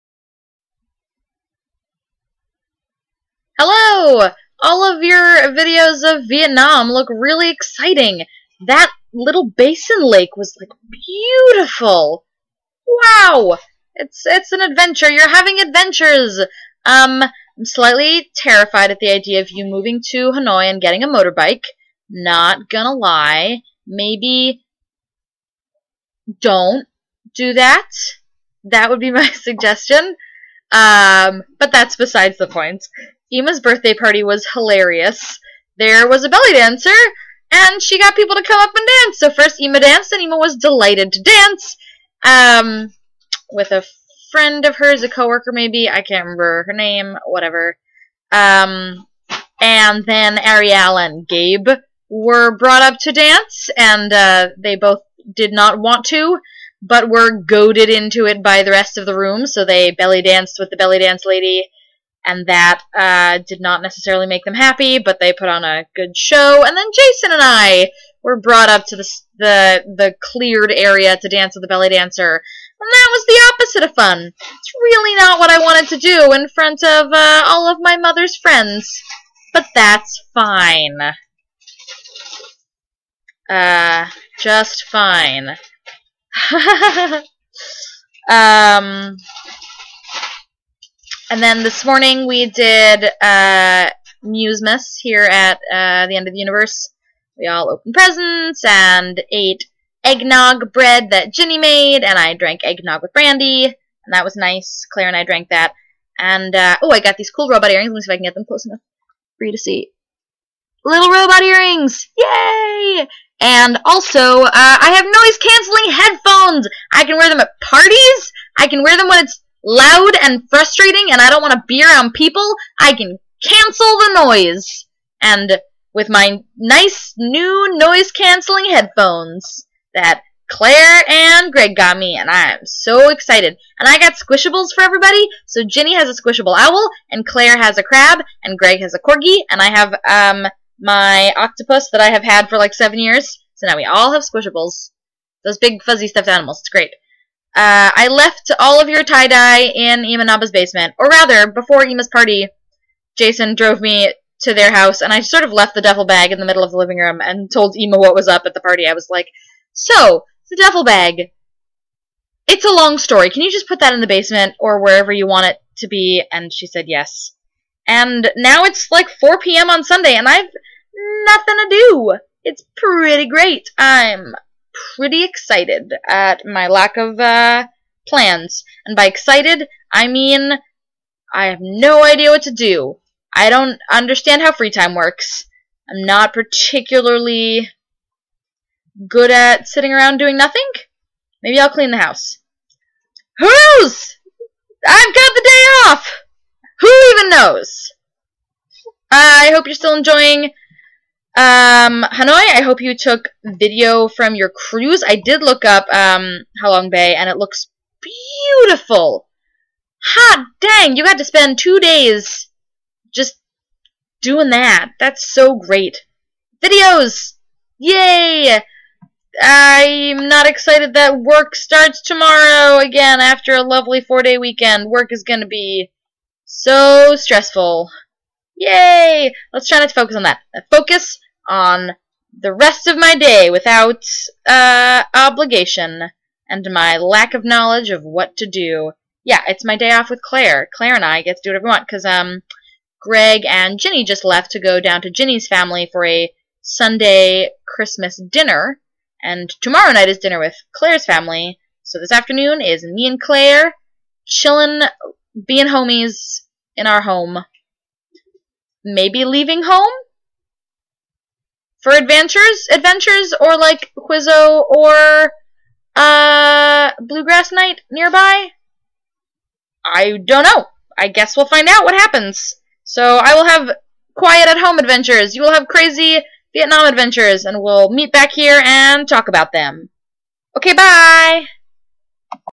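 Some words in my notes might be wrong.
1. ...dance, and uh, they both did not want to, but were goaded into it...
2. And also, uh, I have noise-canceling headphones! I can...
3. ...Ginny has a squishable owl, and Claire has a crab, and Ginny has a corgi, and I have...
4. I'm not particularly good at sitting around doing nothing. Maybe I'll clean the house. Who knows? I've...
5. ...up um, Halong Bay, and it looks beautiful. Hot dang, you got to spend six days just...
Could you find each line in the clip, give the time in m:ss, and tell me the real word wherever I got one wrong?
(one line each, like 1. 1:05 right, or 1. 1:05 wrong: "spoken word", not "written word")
1. 0:53 right
2. 1:53 right
3. 2:15 wrong: "Greg", not "Ginny"
4. 3:05 right
5. 3:25 wrong: "two", not "six".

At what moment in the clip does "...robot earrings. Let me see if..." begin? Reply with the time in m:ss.
1:47.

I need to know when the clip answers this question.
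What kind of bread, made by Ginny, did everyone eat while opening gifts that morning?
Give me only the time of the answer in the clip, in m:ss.
1:40.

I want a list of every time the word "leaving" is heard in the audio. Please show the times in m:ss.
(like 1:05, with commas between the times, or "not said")
4:19.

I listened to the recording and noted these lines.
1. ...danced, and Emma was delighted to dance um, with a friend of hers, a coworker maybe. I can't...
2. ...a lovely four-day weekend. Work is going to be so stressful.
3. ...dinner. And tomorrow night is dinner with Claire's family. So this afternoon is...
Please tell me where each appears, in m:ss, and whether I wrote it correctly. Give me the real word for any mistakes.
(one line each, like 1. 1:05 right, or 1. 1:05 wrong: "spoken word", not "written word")
1. 0:39 right
2. 3:43 right
3. 4:08 right.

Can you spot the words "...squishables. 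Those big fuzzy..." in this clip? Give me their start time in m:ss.
2:24.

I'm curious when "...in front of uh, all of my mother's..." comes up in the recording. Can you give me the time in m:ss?
1:16.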